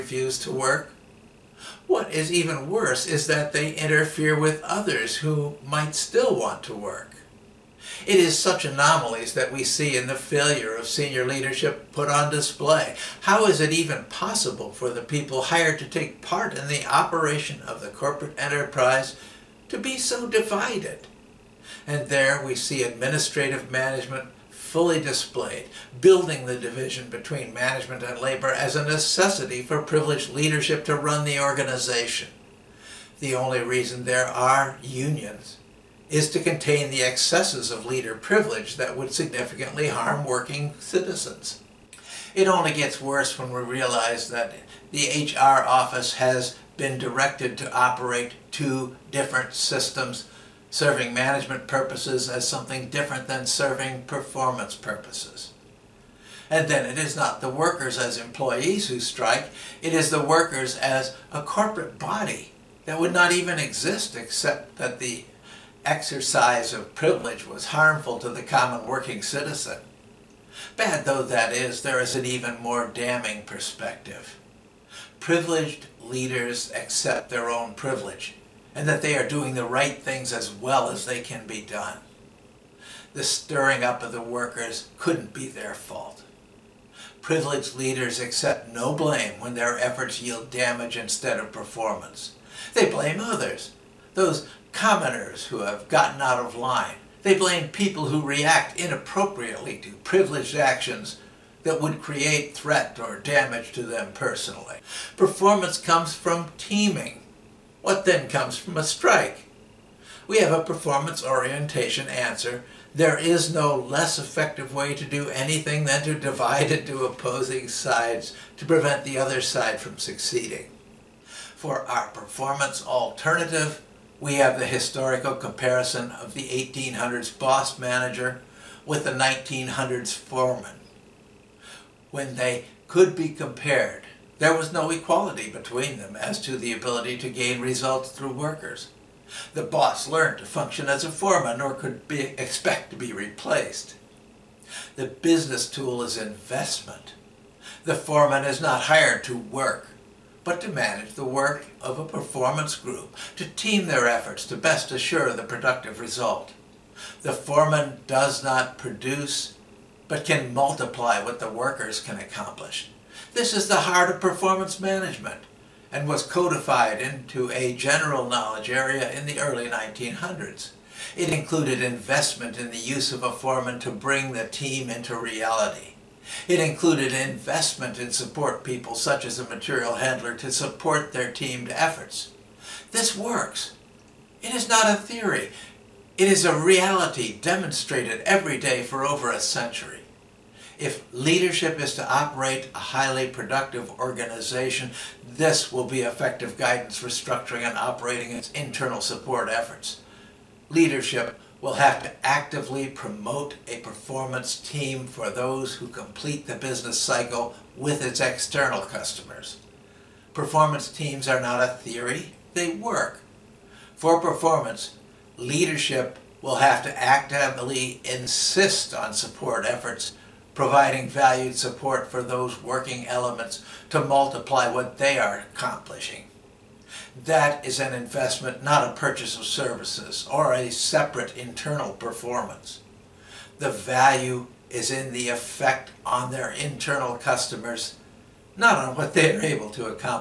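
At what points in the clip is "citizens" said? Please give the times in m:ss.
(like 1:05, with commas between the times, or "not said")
0:40, 1:09.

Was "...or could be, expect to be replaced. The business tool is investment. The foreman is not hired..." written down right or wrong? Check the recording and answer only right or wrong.
right.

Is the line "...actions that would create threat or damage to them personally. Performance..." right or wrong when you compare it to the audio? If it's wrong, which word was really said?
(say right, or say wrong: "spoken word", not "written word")
right.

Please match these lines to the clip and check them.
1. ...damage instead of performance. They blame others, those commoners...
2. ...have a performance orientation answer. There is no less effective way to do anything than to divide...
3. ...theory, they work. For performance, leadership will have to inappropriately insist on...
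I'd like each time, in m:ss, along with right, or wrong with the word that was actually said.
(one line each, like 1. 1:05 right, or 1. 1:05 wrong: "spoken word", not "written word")
1. 1:30 right
2. 1:50 right
3. 3:31 wrong: "actively", not "inappropriately".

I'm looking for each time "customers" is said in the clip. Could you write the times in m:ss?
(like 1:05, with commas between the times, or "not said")
3:28, 3:57.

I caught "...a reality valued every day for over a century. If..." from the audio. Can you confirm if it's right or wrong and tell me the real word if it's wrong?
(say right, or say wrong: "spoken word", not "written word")
wrong: "demonstrated", not "valued".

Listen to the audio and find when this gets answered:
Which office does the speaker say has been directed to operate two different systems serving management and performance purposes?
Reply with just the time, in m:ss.
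0:45.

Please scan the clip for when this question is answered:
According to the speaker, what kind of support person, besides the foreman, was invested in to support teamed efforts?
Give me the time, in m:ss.
2:59.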